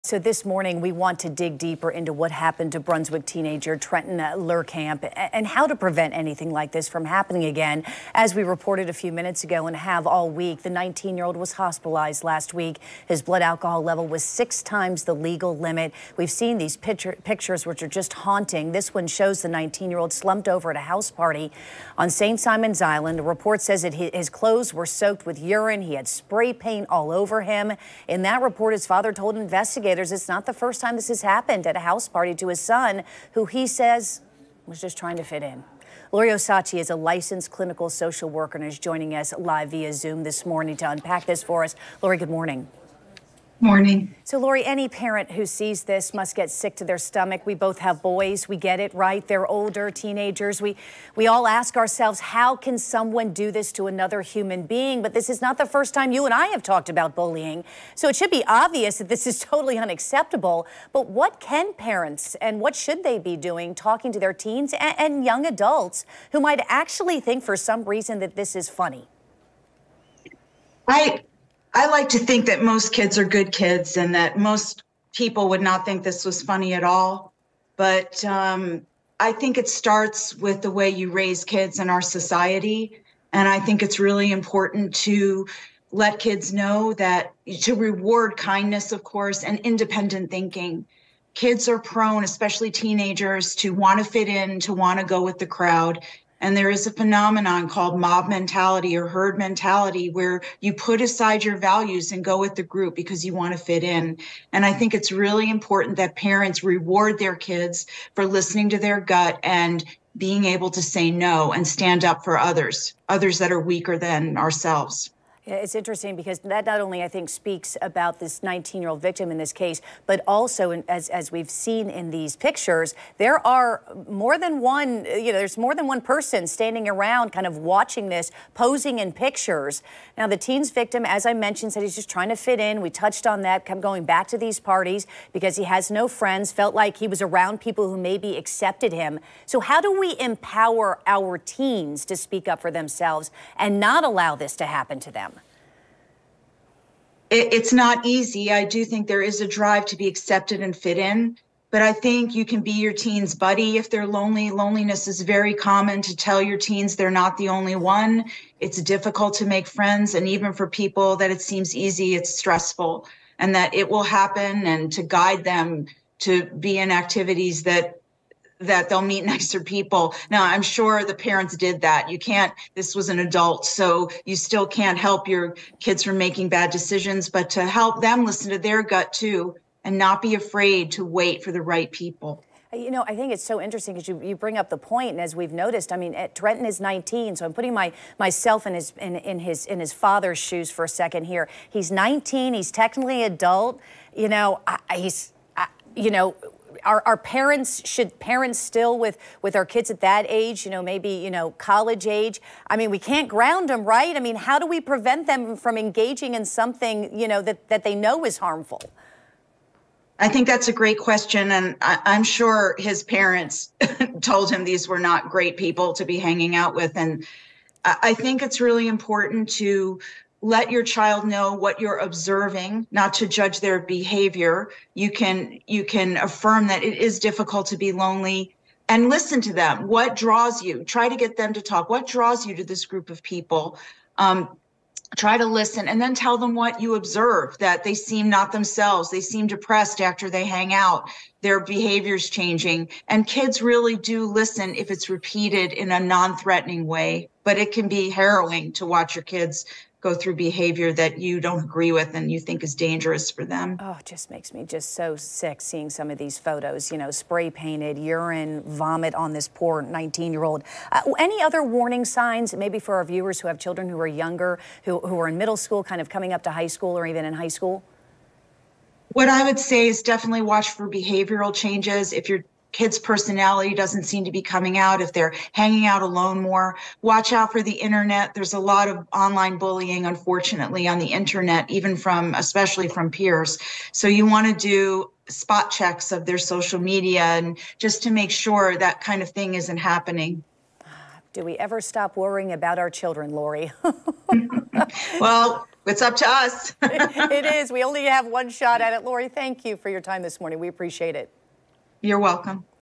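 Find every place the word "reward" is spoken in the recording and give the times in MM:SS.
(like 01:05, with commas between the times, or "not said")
01:27, 01:46.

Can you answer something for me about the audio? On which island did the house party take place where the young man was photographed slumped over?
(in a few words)
St. Simon's Island.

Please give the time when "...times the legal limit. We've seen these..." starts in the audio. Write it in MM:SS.
00:14.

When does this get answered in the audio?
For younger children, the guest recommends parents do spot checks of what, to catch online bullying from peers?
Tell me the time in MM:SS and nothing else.
04:46.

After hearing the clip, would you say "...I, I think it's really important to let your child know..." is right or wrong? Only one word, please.
right.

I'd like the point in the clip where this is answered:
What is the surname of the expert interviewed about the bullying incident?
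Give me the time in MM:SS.
00:36.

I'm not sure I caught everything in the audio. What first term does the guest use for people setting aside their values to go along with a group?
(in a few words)
Mob mentality.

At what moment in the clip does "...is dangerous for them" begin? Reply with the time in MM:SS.
04:12.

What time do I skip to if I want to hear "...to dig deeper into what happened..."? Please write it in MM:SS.
00:01.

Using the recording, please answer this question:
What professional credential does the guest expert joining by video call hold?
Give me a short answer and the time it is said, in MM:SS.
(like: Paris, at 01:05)
Licensed clinical social worker, at 00:36.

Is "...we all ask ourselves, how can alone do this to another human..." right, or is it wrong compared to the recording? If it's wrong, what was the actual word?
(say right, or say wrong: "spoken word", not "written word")
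wrong: "someone", not "alone".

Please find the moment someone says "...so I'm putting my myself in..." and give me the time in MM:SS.
03:07.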